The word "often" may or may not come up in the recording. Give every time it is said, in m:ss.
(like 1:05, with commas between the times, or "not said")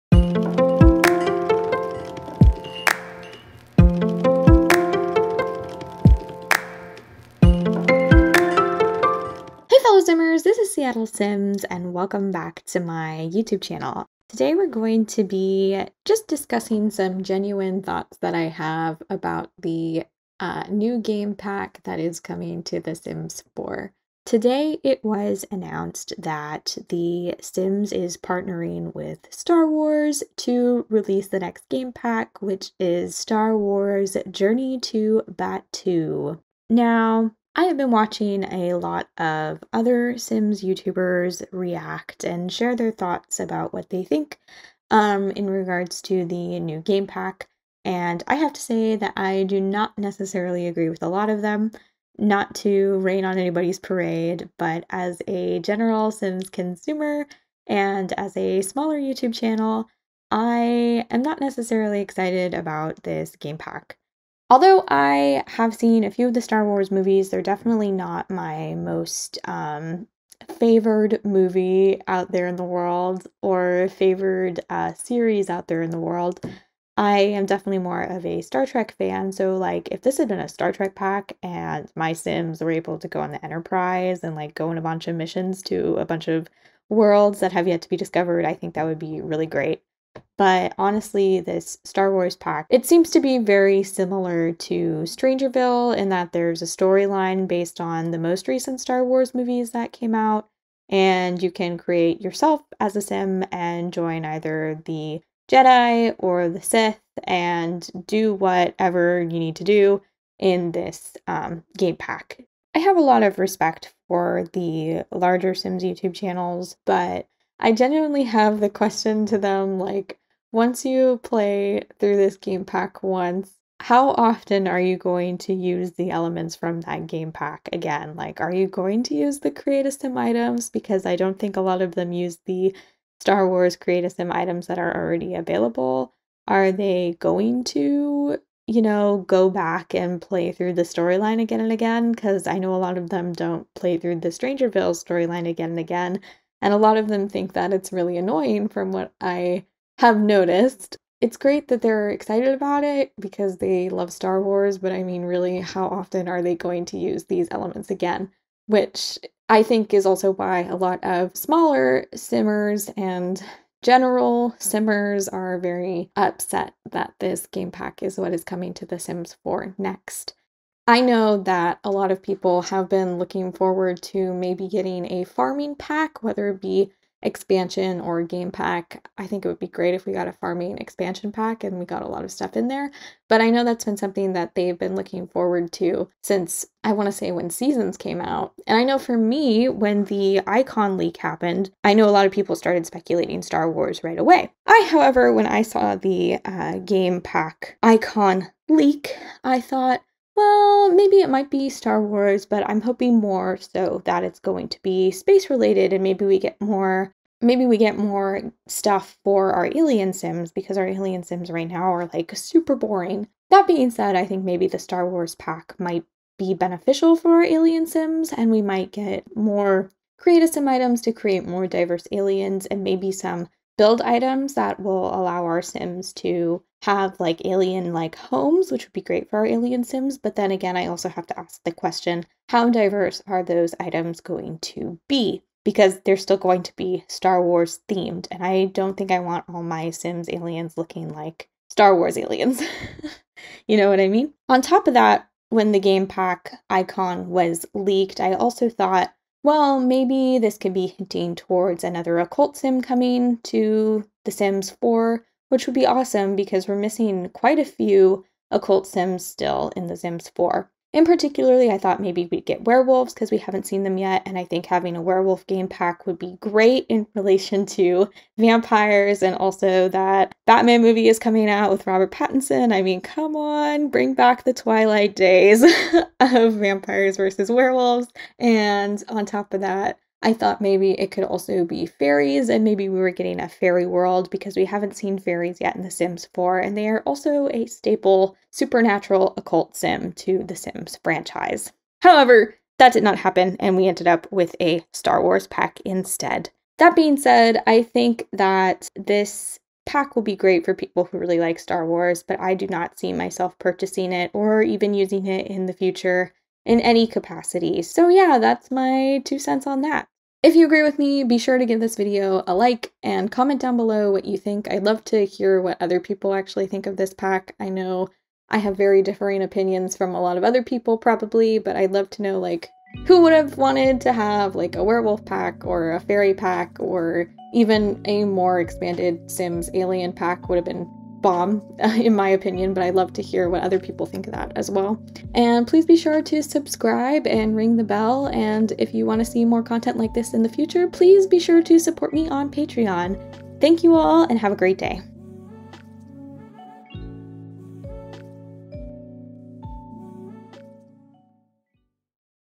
2:04, 2:35.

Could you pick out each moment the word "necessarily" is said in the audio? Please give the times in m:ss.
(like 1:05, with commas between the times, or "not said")
0:49, 1:01.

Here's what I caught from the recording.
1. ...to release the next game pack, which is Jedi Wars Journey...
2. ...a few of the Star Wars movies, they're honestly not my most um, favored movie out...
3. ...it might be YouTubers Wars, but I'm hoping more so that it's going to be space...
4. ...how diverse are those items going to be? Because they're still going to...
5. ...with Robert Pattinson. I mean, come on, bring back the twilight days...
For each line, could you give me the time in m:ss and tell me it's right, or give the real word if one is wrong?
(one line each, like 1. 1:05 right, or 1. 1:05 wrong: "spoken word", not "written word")
1. 0:30 wrong: "Star", not "Jedi"
2. 1:06 wrong: "definitely", not "honestly"
3. 3:21 wrong: "Star", not "YouTubers"
4. 3:52 right
5. 4:31 right.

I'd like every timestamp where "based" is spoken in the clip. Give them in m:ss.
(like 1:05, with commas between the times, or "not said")
1:37.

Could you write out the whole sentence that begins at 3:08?
And I know for me, when the icon leak happened, I know a lot of people started speculating Star Wars right away.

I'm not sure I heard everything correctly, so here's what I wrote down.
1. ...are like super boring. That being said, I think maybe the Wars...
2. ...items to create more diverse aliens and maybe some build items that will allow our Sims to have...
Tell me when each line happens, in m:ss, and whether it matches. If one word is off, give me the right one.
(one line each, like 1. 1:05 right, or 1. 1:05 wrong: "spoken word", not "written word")
1. 3:31 wrong: "Star", not "Wars"
2. 3:40 right.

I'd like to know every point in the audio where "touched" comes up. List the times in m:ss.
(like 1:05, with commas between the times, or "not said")
not said.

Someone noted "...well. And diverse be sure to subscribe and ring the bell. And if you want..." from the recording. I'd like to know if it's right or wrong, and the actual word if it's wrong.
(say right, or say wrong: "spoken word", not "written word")
wrong: "please", not "diverse".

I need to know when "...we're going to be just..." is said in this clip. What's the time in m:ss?
0:14.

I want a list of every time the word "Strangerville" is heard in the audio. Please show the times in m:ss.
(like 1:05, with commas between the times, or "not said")
1:35, 2:24.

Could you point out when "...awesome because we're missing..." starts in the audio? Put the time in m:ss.
4:15.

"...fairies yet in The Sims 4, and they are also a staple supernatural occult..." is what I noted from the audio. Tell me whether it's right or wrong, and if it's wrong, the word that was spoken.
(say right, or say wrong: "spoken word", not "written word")
right.